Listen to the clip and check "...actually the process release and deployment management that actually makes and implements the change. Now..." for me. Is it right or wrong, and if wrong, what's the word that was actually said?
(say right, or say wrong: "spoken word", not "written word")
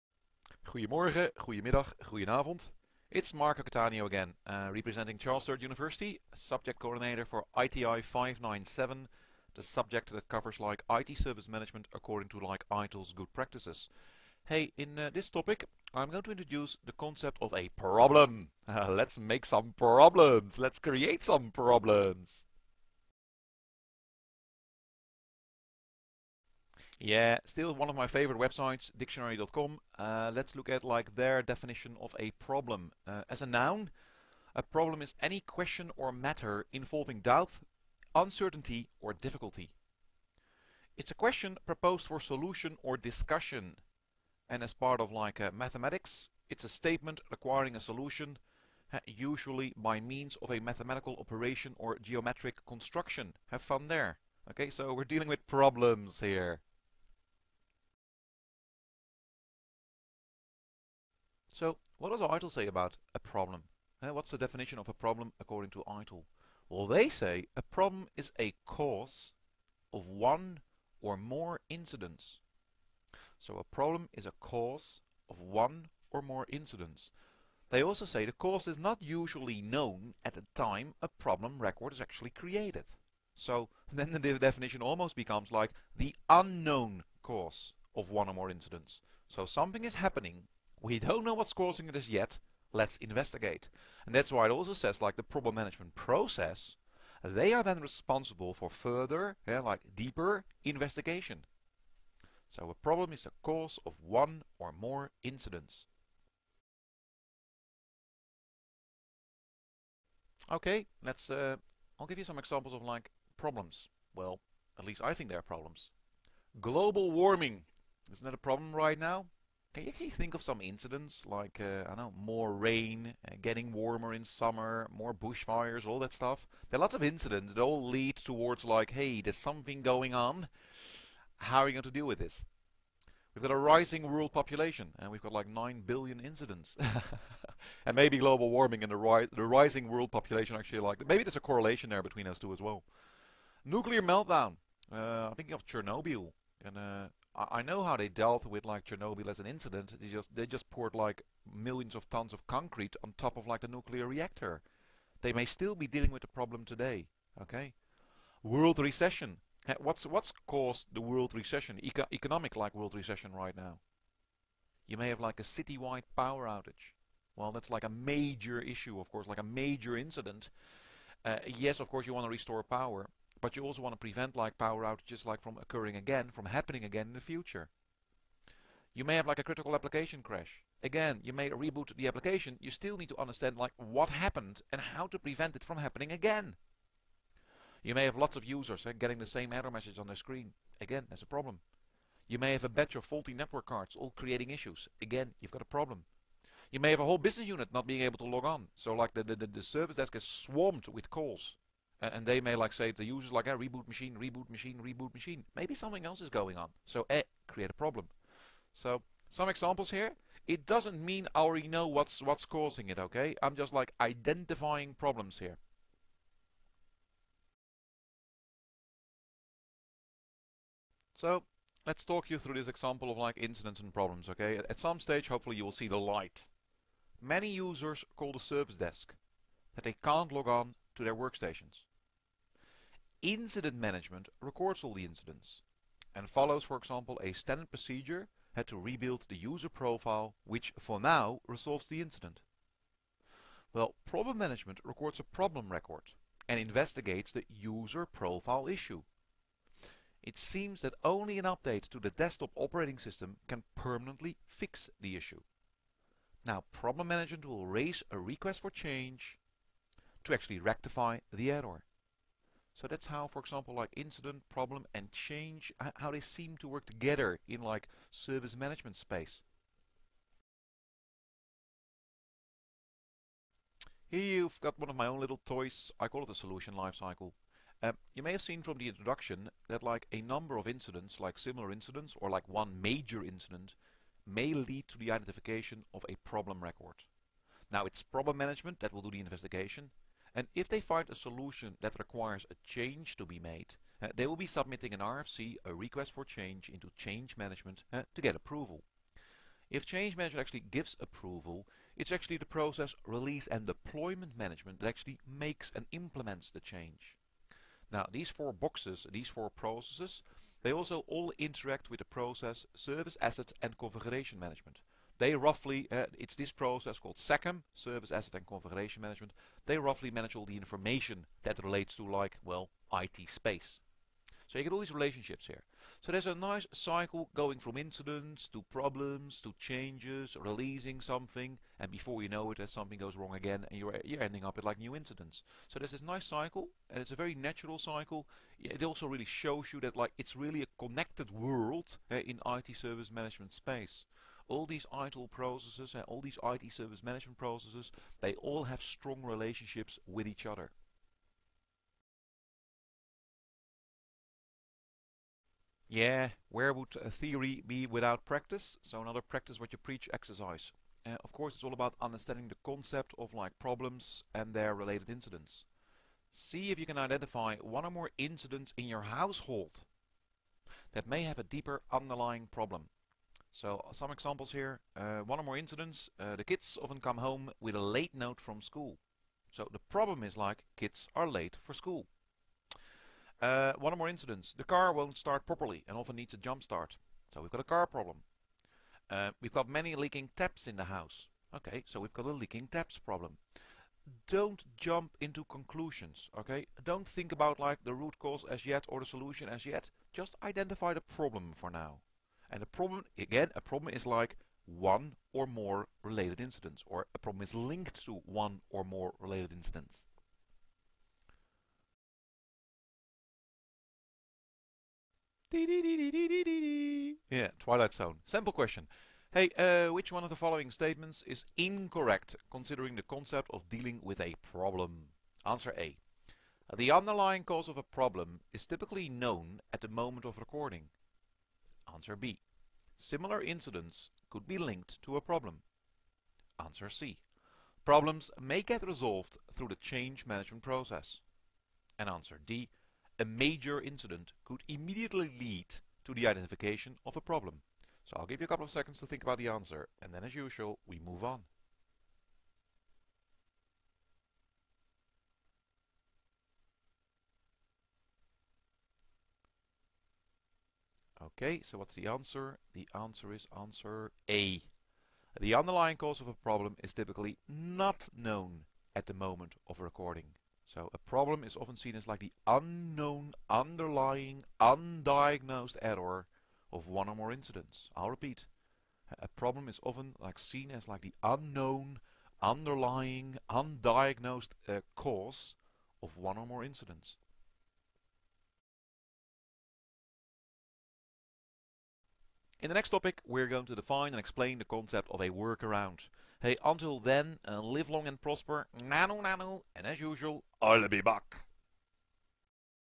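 right.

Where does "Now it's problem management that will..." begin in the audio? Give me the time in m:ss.
4:47.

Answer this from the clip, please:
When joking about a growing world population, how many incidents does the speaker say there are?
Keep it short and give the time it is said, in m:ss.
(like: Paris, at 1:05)
9 billion, at 2:15.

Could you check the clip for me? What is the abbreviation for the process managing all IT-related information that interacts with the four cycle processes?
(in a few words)
SACM.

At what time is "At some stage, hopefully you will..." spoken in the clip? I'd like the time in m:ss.
3:44.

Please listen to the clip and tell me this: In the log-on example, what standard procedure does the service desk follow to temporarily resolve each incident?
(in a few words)
Rebuild the user profile.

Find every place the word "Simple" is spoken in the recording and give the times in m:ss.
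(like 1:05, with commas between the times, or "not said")
6:58.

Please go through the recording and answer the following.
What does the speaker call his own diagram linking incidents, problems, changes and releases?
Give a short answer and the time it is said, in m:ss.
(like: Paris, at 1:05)
Solution lifecycle, at 4:36.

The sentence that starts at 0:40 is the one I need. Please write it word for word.
It's a question proposed for solution or discussion.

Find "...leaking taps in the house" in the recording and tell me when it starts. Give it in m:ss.
6:29.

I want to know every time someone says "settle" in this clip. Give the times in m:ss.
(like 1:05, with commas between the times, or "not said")
not said.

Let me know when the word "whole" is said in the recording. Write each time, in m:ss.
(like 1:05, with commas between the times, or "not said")
3:17.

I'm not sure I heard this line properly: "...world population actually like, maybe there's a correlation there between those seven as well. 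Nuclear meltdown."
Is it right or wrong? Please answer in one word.
wrong.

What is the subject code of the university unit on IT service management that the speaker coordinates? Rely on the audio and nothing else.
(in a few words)
ITI 597.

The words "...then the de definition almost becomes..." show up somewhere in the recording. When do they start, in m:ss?
1:23.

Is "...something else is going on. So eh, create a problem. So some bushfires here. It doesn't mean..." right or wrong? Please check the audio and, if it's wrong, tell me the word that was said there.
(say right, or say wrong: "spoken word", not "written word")
wrong: "examples", not "bushfires".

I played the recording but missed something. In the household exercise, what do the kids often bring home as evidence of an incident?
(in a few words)
A late note.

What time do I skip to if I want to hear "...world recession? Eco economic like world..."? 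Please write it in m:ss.
2:41.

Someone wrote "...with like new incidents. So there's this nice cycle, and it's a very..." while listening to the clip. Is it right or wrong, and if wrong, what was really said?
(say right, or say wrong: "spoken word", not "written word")
right.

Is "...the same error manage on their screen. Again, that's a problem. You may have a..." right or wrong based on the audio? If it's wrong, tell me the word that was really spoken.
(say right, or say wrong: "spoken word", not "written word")
wrong: "message", not "manage".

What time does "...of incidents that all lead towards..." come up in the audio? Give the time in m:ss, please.
2:06.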